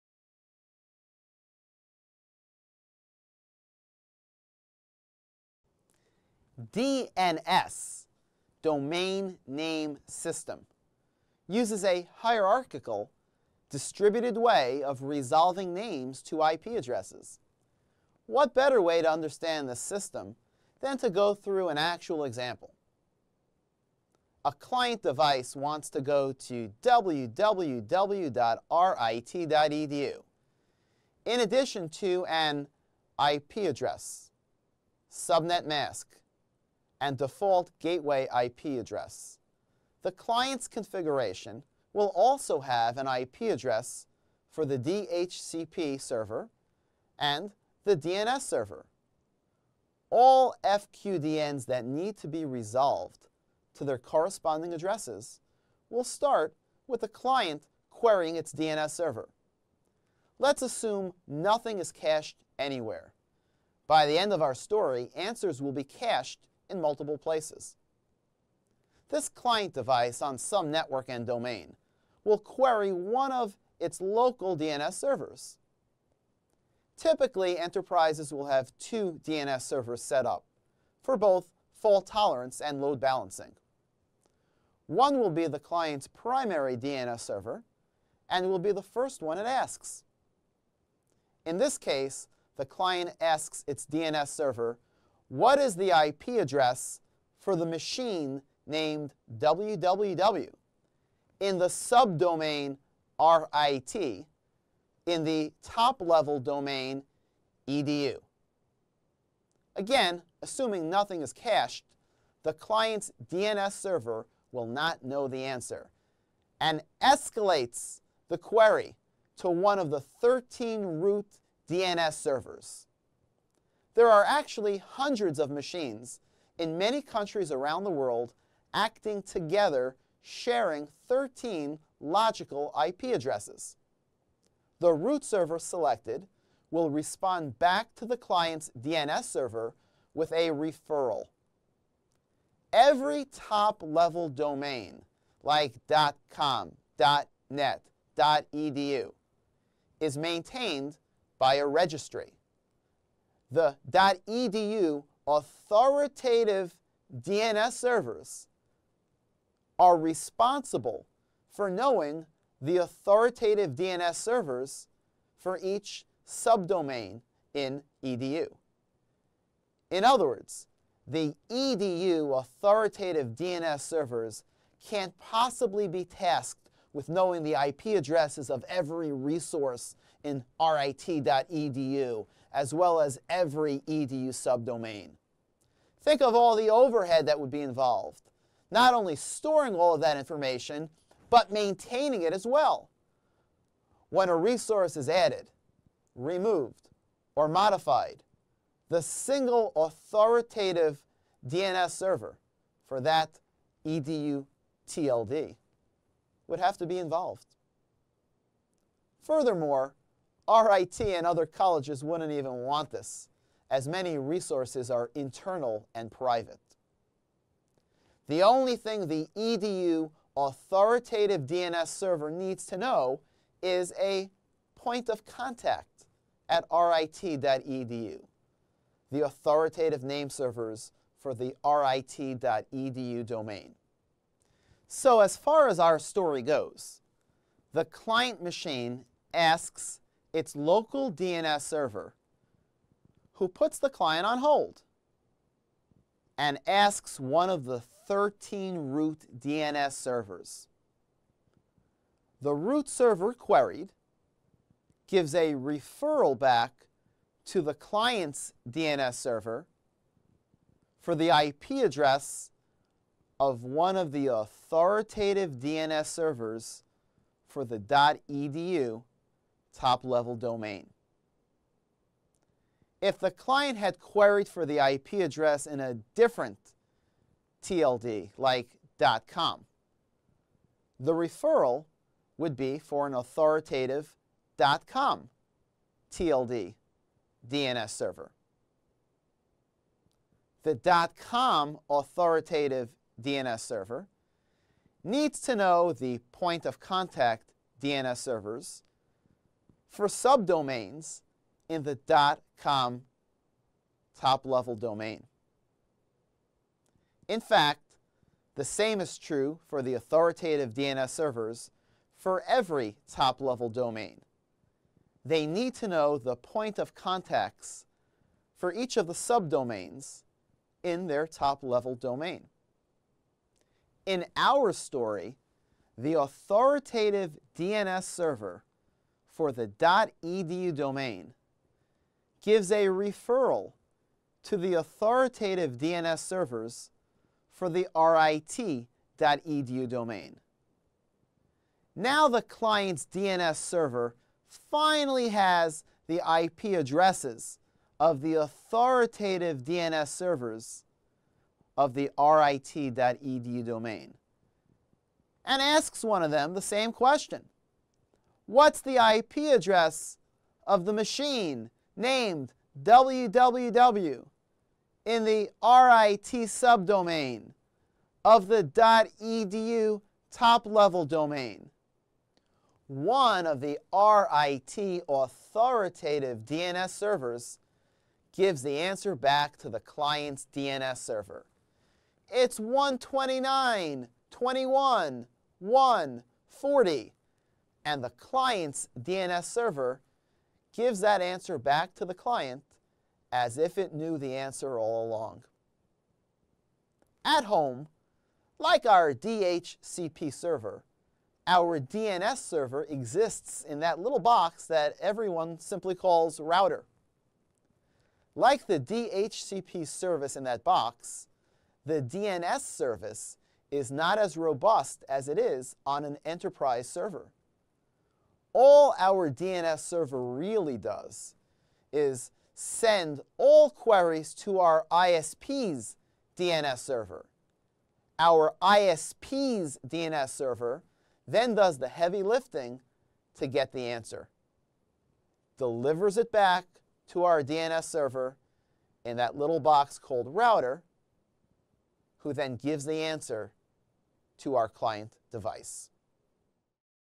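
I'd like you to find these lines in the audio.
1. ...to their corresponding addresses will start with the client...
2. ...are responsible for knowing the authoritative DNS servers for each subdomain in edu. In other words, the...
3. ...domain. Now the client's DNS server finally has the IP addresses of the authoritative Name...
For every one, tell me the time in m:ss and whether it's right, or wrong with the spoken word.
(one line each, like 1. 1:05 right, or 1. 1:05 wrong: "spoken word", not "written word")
1. 0:53 right
2. 2:39 right
3. 5:39 wrong: "DNS", not "Name".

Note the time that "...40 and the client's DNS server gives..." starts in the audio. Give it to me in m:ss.
6:26.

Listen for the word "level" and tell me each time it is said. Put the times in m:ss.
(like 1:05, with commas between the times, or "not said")
1:45, 2:23, 4:30, 5:04, 5:13, 5:21, 6:10.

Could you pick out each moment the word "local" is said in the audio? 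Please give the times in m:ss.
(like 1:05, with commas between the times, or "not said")
1:13, 4:00.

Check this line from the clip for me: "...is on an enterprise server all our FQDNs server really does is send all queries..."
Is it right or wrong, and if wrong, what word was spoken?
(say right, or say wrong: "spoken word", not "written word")
wrong: "DNS", not "FQDNs".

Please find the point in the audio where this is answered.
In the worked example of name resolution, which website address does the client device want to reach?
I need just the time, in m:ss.
0:26.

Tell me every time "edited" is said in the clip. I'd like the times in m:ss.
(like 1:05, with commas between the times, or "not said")
not said.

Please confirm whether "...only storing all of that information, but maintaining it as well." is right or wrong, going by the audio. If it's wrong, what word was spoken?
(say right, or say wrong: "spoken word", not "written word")
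right.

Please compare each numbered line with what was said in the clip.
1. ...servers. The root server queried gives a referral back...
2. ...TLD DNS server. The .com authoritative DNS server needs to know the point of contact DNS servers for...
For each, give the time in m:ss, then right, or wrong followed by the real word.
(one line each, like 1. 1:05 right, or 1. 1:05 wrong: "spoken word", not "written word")
1. 4:09 right
2. 4:46 right.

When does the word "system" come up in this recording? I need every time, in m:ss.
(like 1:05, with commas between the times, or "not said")
0:10, 0:19.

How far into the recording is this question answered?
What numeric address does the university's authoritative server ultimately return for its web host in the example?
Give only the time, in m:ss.
6:22.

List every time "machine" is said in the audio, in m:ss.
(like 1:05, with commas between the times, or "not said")
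1:37, 2:05, 3:58, 6:00.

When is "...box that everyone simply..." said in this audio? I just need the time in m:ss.
6:44.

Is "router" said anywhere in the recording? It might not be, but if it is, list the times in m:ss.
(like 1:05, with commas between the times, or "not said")
6:46, 7:20.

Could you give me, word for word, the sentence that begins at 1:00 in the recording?
Let's assume nothing is cached anywhere.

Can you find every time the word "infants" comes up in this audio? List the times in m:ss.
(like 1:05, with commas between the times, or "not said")
not said.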